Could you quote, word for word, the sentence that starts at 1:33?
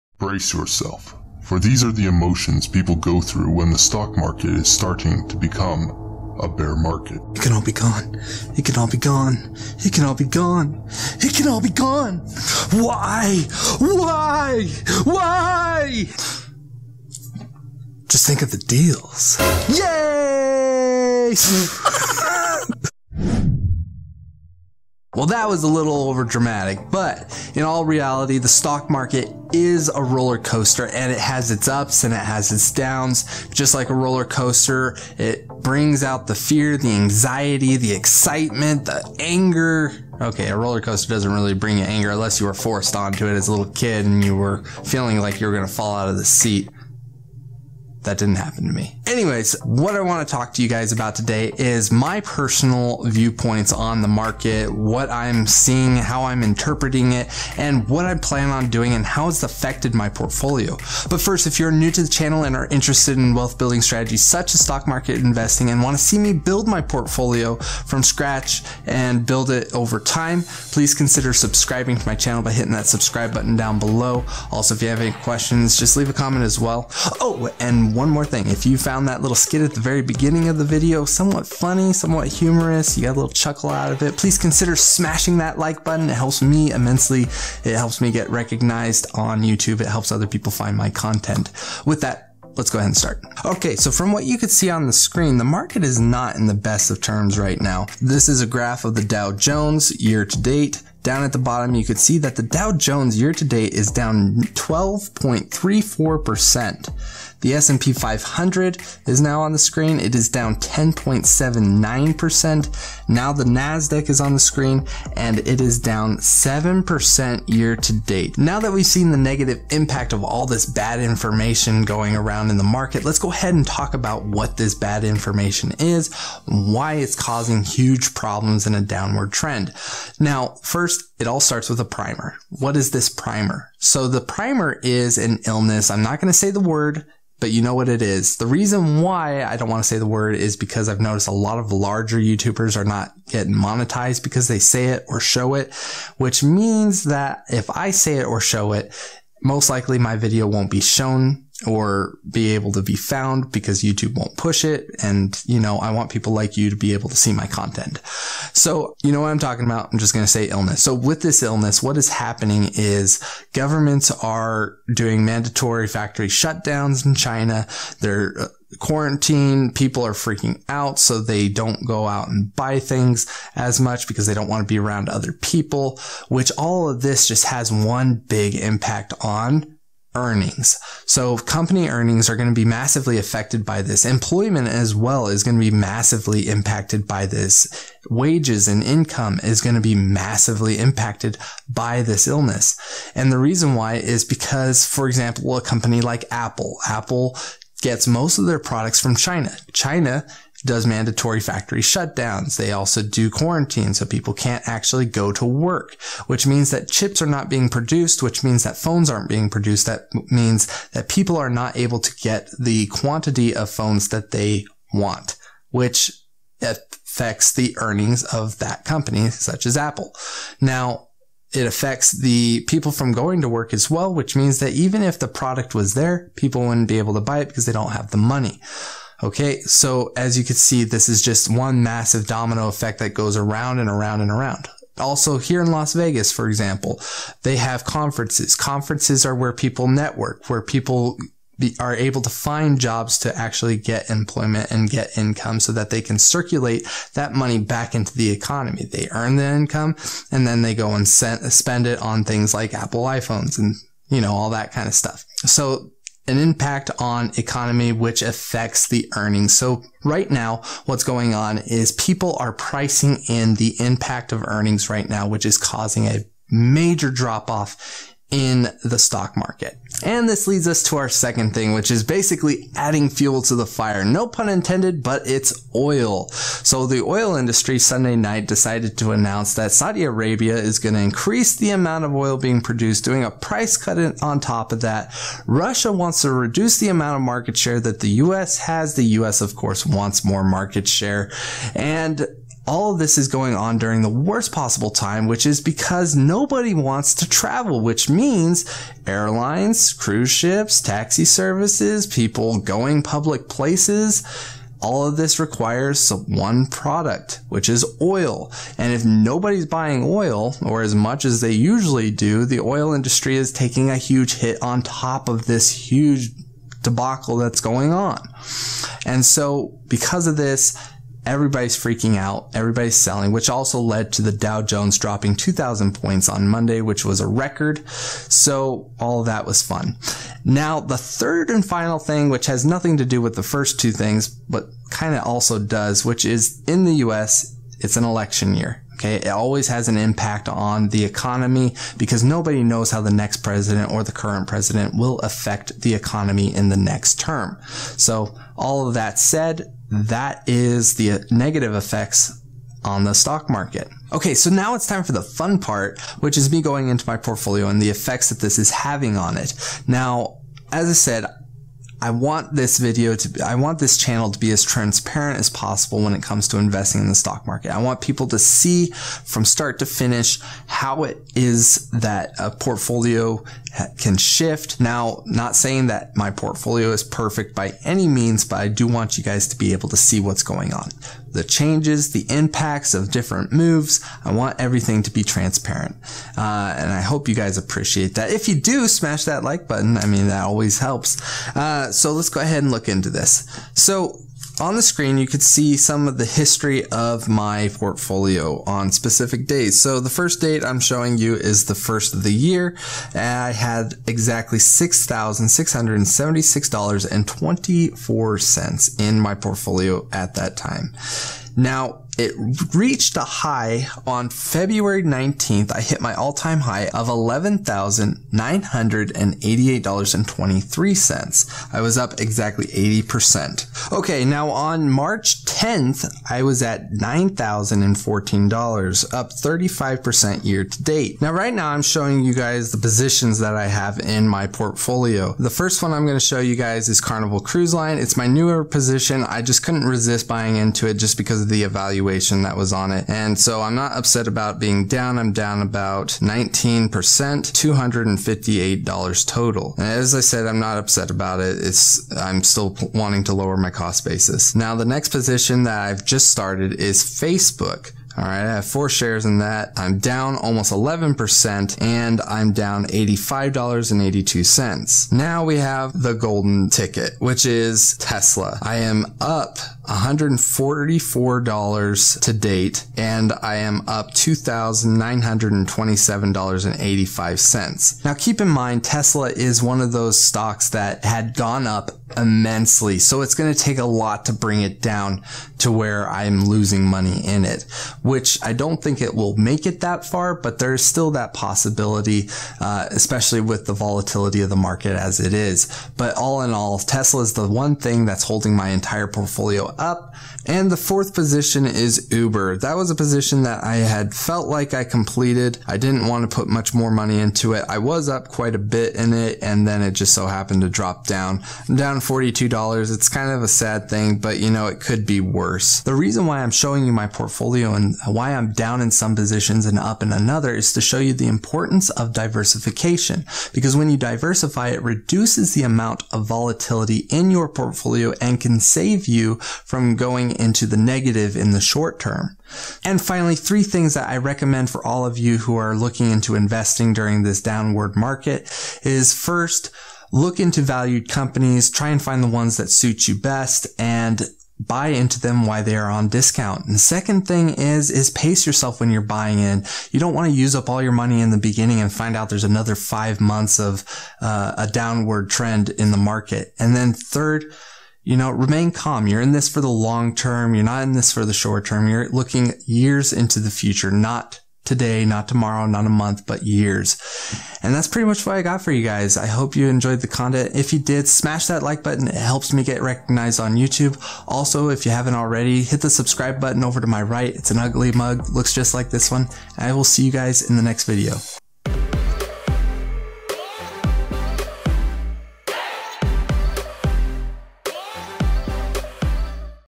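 Okay, so from what you could see on the screen, the market is not in the best of terms right now.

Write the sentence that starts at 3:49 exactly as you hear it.
Okay, so as you can see, this is just one massive domino effect that goes around and around and around.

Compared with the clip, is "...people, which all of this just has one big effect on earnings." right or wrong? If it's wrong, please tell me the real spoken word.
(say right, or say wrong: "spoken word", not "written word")
wrong: "impact", not "effect".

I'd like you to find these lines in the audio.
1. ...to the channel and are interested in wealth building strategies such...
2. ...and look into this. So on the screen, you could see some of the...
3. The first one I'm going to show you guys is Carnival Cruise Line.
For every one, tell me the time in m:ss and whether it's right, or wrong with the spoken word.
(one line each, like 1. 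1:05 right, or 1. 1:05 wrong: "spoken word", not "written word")
1. 1:01 right
2. 6:32 right
3. 7:15 right.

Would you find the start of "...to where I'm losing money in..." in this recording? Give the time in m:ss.
8:05.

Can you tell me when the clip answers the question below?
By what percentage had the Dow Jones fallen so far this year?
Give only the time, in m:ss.
1:44.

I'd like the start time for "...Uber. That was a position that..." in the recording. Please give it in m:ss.
8:22.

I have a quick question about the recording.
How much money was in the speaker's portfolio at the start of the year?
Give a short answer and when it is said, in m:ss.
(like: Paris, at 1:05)
$6,676.24, at 6:44.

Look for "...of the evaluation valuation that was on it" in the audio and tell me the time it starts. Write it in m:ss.
7:21.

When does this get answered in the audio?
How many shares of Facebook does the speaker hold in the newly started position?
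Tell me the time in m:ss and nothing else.
7:38.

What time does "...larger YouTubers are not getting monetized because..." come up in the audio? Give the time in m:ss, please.
2:21.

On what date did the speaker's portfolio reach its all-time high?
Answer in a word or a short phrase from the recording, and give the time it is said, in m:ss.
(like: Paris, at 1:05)
February 19th, at 6:54.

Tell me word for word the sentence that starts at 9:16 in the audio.
And then third, you know, remain calm.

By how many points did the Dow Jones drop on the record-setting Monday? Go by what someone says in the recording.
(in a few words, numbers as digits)
2,000.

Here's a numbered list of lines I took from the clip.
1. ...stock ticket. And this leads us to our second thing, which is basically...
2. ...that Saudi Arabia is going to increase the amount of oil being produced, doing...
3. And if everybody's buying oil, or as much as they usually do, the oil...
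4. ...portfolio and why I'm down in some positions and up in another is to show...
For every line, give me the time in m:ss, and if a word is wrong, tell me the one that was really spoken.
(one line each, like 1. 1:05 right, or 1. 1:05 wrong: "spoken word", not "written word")
1. 4:28 wrong: "market", not "ticket"
2. 4:39 right
3. 5:08 wrong: "nobody", not "everybody"
4. 8:37 right.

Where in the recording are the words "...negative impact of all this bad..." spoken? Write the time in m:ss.
1:59.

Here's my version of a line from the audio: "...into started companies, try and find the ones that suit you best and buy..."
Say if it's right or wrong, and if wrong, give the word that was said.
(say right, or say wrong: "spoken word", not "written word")
wrong: "valued", not "started".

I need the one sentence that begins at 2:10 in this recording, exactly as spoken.
Now, first, it all starts with a primer.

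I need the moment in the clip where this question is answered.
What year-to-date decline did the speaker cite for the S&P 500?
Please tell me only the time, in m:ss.
1:50.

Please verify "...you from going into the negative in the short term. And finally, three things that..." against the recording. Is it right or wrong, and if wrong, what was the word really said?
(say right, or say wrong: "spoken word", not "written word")
right.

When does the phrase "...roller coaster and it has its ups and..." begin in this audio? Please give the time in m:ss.
0:30.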